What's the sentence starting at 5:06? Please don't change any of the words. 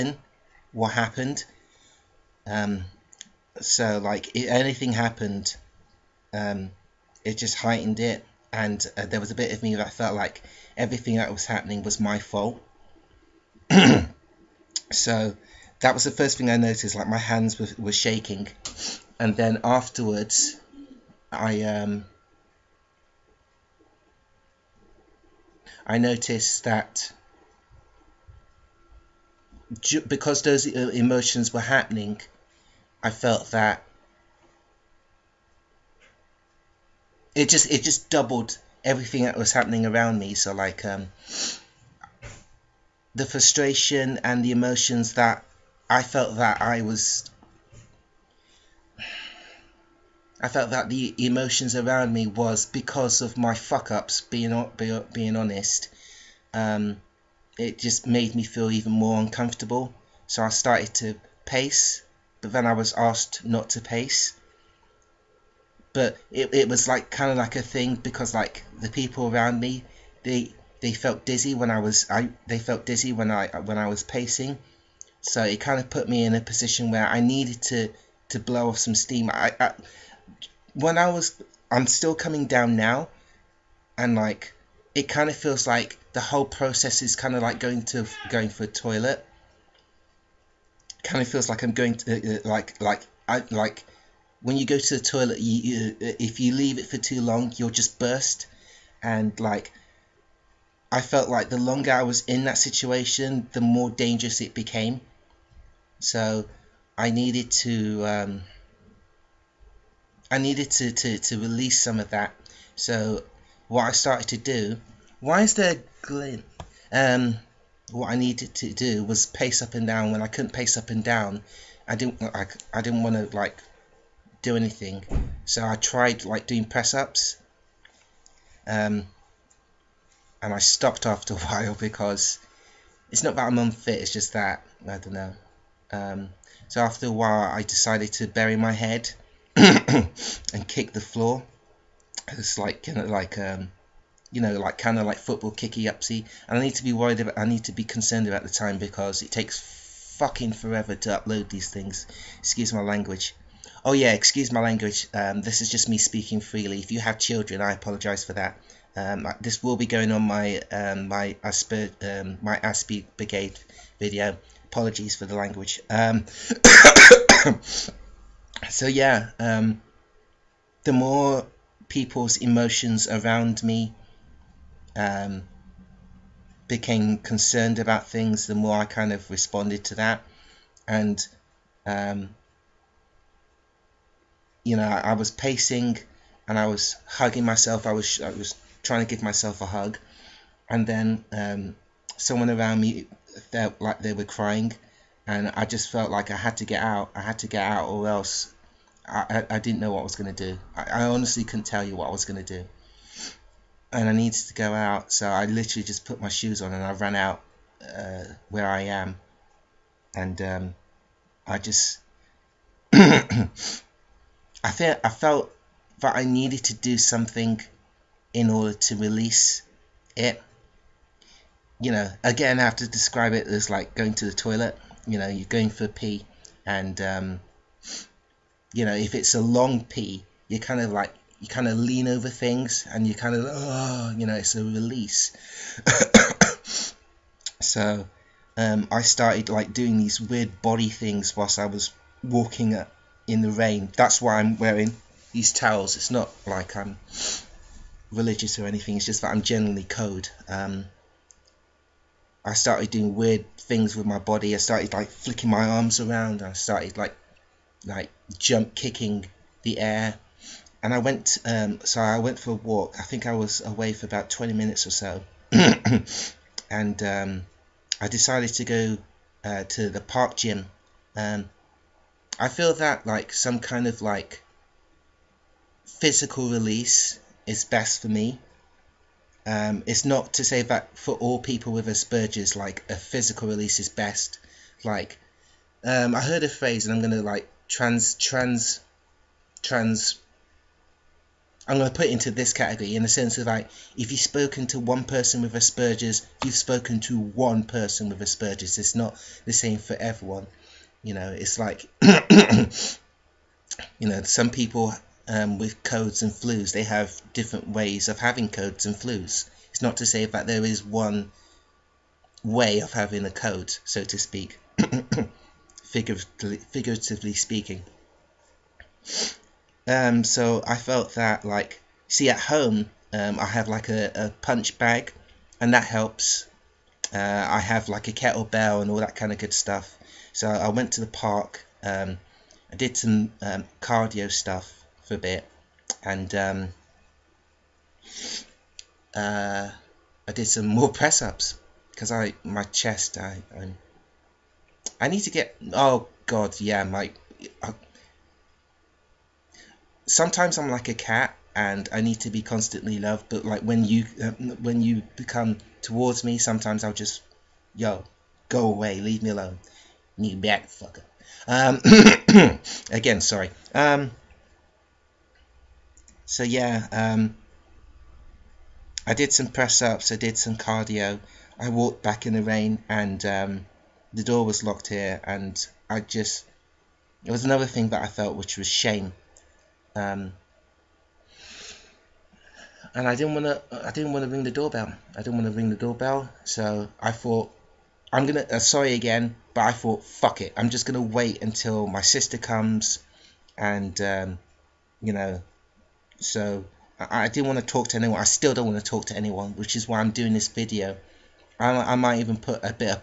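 They have different ways of having codes and flus.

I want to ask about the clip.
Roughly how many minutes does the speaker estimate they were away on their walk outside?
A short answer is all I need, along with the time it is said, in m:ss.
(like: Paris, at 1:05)
20, at 4:24.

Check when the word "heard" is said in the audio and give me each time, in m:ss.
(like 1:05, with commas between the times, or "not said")
4:46.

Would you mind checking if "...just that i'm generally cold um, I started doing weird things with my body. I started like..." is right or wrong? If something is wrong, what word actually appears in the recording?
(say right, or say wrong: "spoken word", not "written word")
right.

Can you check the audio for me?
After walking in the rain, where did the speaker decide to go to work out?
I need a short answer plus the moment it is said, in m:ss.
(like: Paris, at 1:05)
park gym, at 4:30.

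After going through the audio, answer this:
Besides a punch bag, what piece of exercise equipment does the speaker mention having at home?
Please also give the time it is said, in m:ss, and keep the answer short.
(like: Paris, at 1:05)
kettlebell, at 5:28.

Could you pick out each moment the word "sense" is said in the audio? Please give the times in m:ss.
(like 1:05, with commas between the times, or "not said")
4:53.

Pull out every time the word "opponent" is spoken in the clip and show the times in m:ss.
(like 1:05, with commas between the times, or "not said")
not said.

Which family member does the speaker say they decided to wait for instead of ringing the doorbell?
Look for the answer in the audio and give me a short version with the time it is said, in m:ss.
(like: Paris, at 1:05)
sister, at 6:31.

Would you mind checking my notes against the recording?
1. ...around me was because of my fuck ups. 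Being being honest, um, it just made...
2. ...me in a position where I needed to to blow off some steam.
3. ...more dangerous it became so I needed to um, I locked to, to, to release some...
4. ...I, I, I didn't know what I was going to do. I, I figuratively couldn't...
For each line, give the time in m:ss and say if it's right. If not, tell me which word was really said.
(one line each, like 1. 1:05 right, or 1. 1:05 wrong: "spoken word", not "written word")
1. 0:51 right
2. 1:16 right
3. 1:43 wrong: "needed", not "locked"
4. 3:19 wrong: "honestly", not "figuratively".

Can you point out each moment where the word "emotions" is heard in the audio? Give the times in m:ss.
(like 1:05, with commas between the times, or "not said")
0:30, 0:44, 0:51, 2:52.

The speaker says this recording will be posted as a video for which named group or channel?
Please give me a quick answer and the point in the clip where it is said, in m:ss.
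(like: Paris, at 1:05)
Aspie Brigade, at 2:42.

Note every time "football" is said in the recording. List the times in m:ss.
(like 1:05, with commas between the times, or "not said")
2:25.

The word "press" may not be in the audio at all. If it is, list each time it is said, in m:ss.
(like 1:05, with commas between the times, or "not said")
2:06, 5:40, 6:09.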